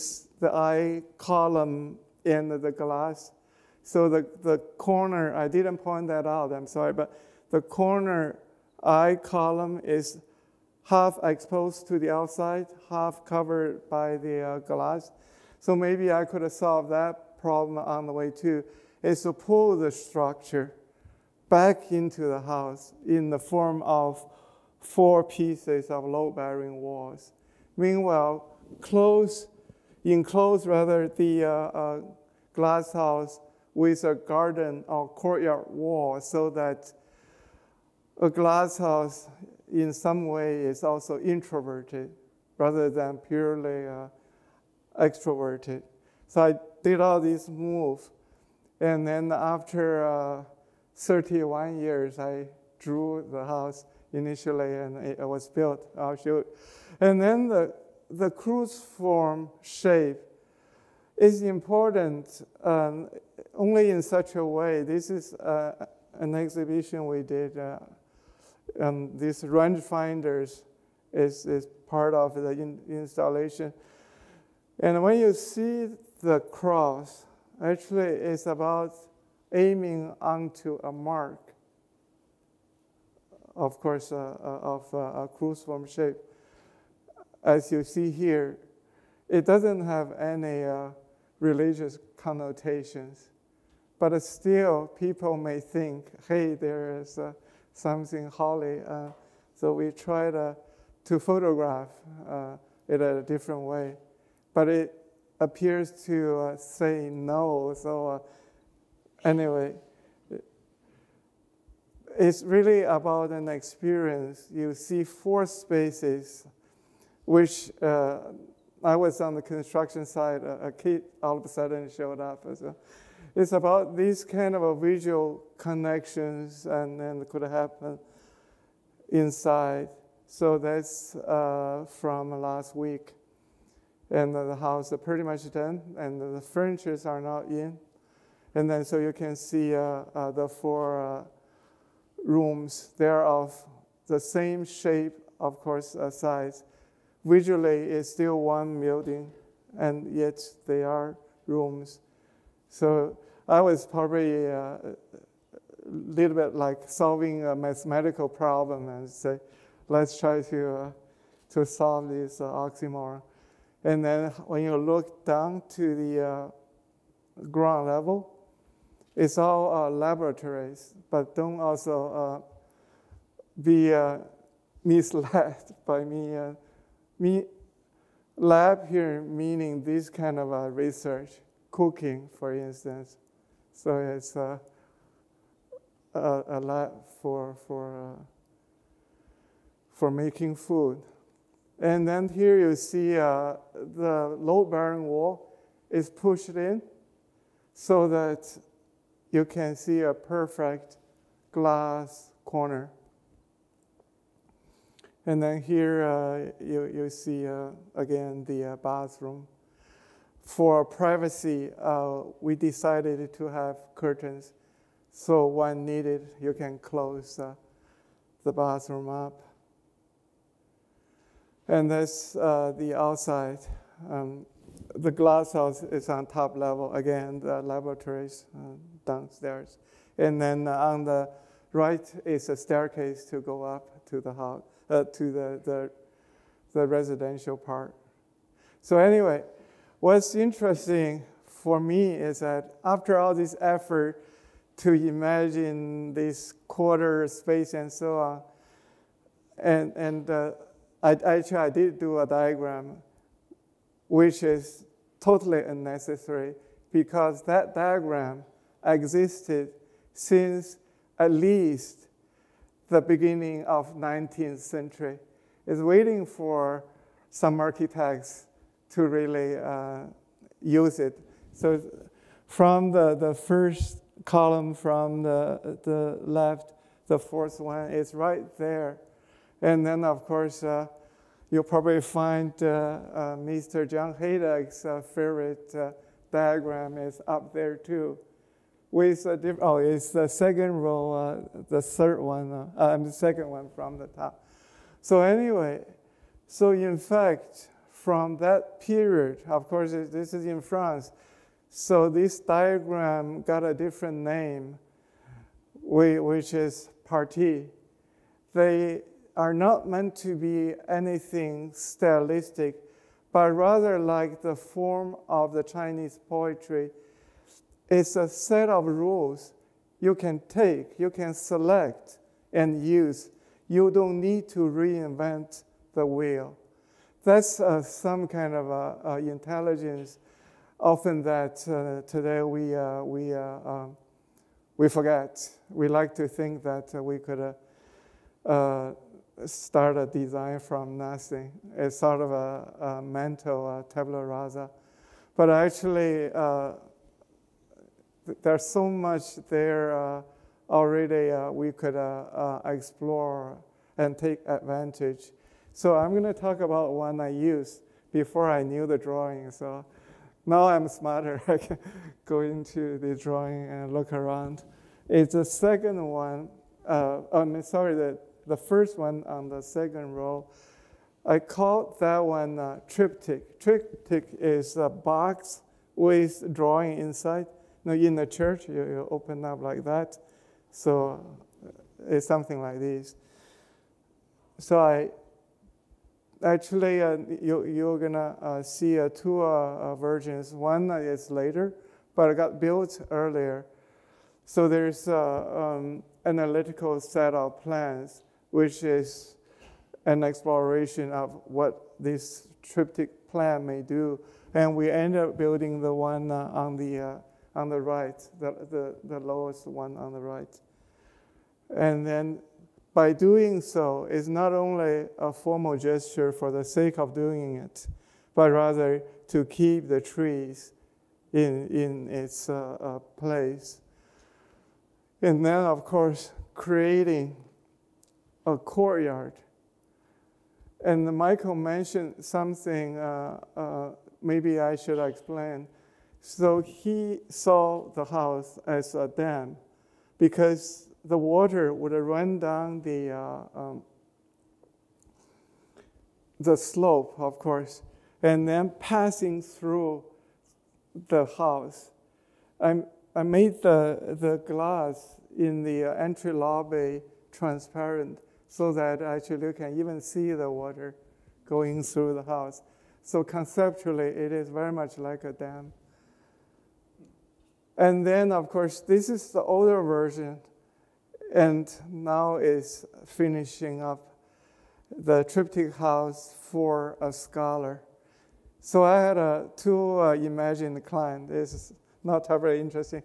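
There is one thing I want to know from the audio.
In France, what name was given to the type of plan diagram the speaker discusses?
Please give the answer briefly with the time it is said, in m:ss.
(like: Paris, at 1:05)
parti, at 5:07.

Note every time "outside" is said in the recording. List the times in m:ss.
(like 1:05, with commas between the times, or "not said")
0:12, 3:42.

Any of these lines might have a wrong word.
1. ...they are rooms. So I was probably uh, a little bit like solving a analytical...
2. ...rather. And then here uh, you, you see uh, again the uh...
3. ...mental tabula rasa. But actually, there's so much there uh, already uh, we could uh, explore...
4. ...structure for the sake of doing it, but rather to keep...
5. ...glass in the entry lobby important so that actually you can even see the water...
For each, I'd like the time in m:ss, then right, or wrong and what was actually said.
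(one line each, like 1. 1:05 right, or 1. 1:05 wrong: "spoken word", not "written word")
1. 2:30 wrong: "mathematical", not "analytical"
2. 3:22 wrong: "corner", not "rather"
3. 5:43 right
4. 6:55 wrong: "gesture", not "structure"
5. 7:34 wrong: "transparent", not "important".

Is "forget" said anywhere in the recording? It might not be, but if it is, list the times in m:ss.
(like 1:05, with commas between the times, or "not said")
5:34.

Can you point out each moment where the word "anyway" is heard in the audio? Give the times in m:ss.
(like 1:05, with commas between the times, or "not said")
1:49, 3:58, 4:55.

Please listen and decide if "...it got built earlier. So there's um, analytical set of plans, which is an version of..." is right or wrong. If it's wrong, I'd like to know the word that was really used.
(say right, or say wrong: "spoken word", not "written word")
wrong: "exploration", not "version".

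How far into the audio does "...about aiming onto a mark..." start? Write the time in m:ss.
1:18.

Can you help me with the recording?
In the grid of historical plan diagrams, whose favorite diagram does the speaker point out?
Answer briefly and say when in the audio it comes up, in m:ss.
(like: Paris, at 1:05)
John Hejduk, at 4:43.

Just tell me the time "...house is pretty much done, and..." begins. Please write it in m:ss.
2:14.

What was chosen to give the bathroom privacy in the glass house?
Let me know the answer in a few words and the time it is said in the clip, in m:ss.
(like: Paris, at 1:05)
curtains, at 3:33.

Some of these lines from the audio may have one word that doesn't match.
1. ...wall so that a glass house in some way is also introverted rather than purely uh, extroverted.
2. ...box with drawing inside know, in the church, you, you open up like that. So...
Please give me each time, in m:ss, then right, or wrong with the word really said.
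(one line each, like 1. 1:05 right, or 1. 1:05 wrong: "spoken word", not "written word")
1. 0:35 right
2. 6:14 right.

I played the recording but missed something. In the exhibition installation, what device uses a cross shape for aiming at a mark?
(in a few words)
rangefinders.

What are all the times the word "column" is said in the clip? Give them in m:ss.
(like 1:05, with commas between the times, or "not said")
0:01, 0:09, 4:34.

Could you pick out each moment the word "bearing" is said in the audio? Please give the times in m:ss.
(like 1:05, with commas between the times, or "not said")
0:26, 3:14.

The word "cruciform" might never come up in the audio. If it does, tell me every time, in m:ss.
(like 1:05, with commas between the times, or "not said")
0:58, 1:25.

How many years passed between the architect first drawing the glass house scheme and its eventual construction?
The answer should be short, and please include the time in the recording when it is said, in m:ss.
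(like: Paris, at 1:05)
31, at 0:50.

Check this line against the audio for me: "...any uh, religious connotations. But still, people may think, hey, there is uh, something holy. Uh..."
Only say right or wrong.
right.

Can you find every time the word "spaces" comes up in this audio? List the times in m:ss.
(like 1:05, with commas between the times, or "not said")
1:55, 4:07.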